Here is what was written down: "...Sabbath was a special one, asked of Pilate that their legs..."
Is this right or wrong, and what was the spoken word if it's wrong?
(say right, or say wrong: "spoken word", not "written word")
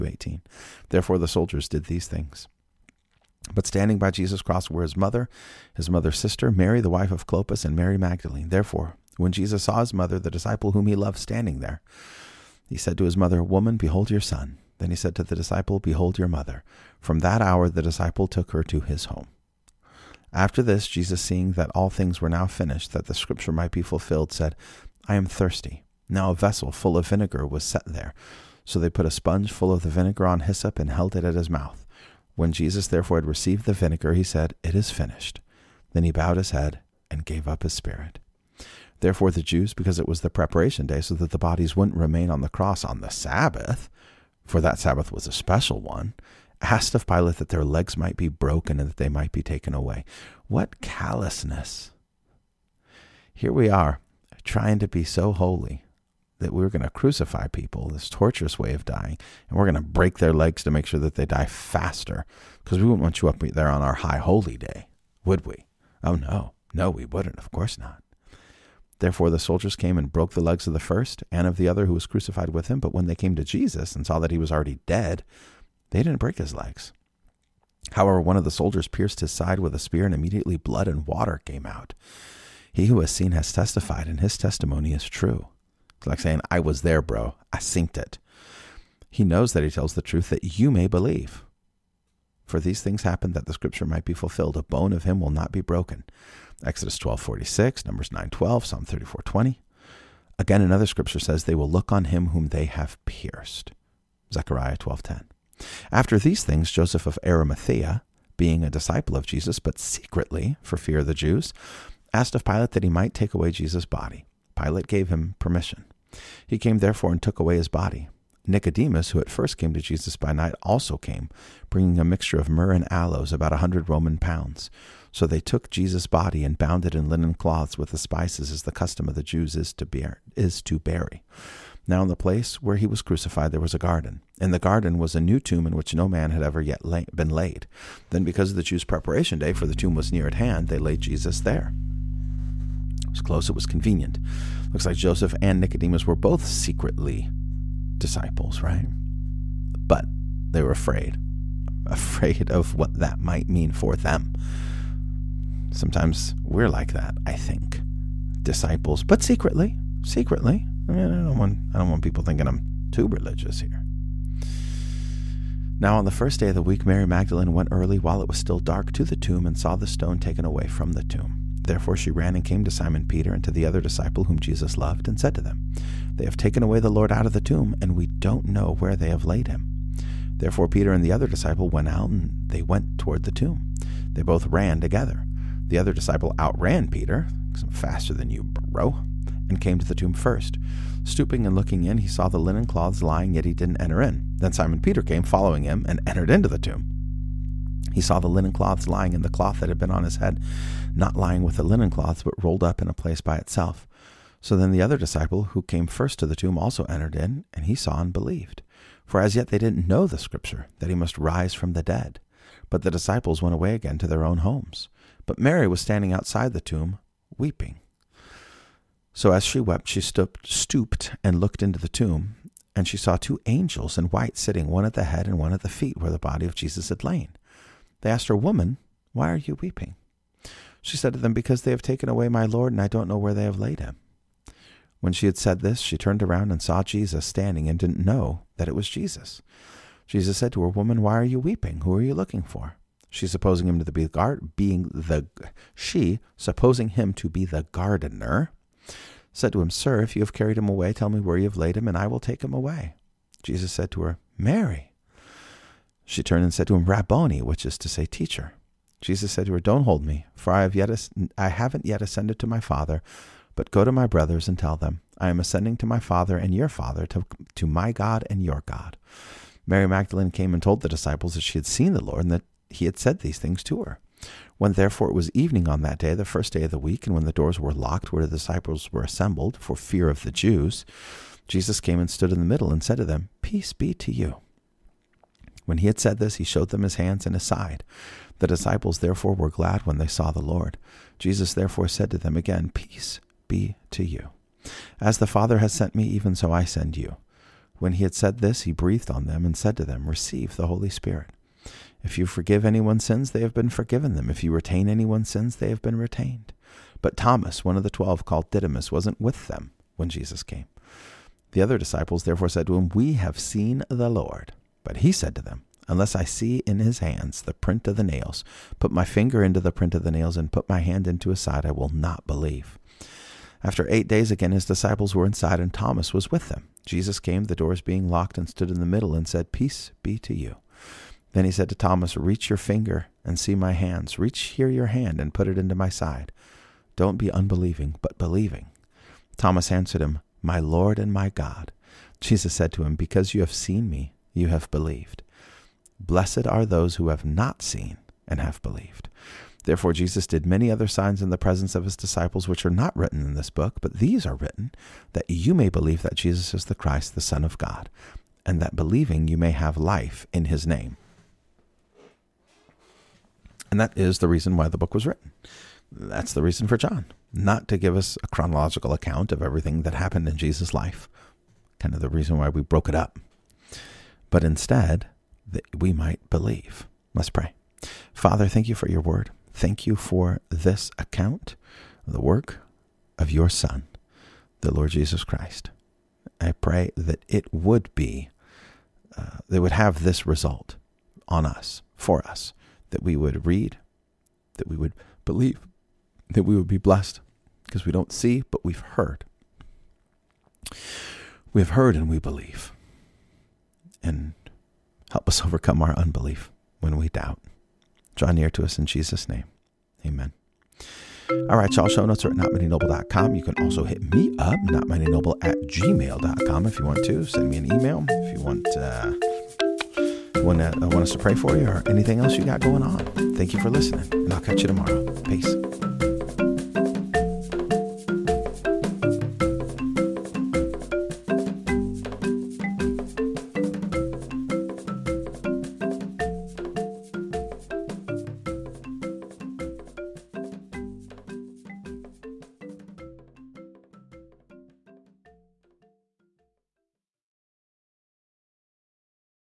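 right.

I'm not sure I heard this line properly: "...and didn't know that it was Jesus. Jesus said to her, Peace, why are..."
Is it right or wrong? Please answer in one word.
wrong.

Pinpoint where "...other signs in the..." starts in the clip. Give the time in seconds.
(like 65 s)
350 s.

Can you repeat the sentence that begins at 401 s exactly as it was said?
We have heard and we believe.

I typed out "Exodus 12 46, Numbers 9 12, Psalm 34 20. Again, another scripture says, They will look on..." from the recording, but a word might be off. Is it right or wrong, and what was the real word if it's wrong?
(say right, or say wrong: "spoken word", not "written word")
right.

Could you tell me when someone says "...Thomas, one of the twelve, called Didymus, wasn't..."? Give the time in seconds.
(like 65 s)
307 s.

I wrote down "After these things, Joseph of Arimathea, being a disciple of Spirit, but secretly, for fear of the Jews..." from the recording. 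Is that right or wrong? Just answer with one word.
wrong.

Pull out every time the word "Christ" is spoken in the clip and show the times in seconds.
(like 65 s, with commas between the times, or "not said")
356 s, 385 s.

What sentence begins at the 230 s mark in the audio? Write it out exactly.
She said to them, Because they have taken away my Lord, and I don't know where they have laid him.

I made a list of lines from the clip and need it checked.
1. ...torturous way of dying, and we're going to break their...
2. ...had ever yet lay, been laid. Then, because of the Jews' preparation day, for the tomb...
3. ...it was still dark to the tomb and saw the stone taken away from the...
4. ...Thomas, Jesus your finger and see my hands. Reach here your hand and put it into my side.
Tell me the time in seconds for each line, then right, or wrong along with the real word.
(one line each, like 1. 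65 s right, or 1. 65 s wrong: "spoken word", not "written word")
1. 58 s right
2. 136 s right
3. 168 s right
4. 331 s wrong: "Reach", not "Jesus".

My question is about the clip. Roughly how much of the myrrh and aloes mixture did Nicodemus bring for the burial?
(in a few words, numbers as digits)
100 Roman pounds.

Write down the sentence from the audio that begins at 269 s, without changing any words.
Mary Magdalene came and told the disciples that she had seen the Lord and that he had said these things to her.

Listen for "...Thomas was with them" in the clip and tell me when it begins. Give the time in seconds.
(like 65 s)
325 s.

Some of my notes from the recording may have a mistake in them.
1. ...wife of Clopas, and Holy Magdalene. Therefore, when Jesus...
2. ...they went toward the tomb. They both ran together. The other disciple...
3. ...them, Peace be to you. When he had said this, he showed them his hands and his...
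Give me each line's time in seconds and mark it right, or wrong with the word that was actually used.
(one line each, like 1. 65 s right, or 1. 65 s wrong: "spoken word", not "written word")
1. 6 s wrong: "Mary", not "Holy"
2. 182 s right
3. 283 s right.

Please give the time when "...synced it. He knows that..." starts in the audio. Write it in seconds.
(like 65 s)
87 s.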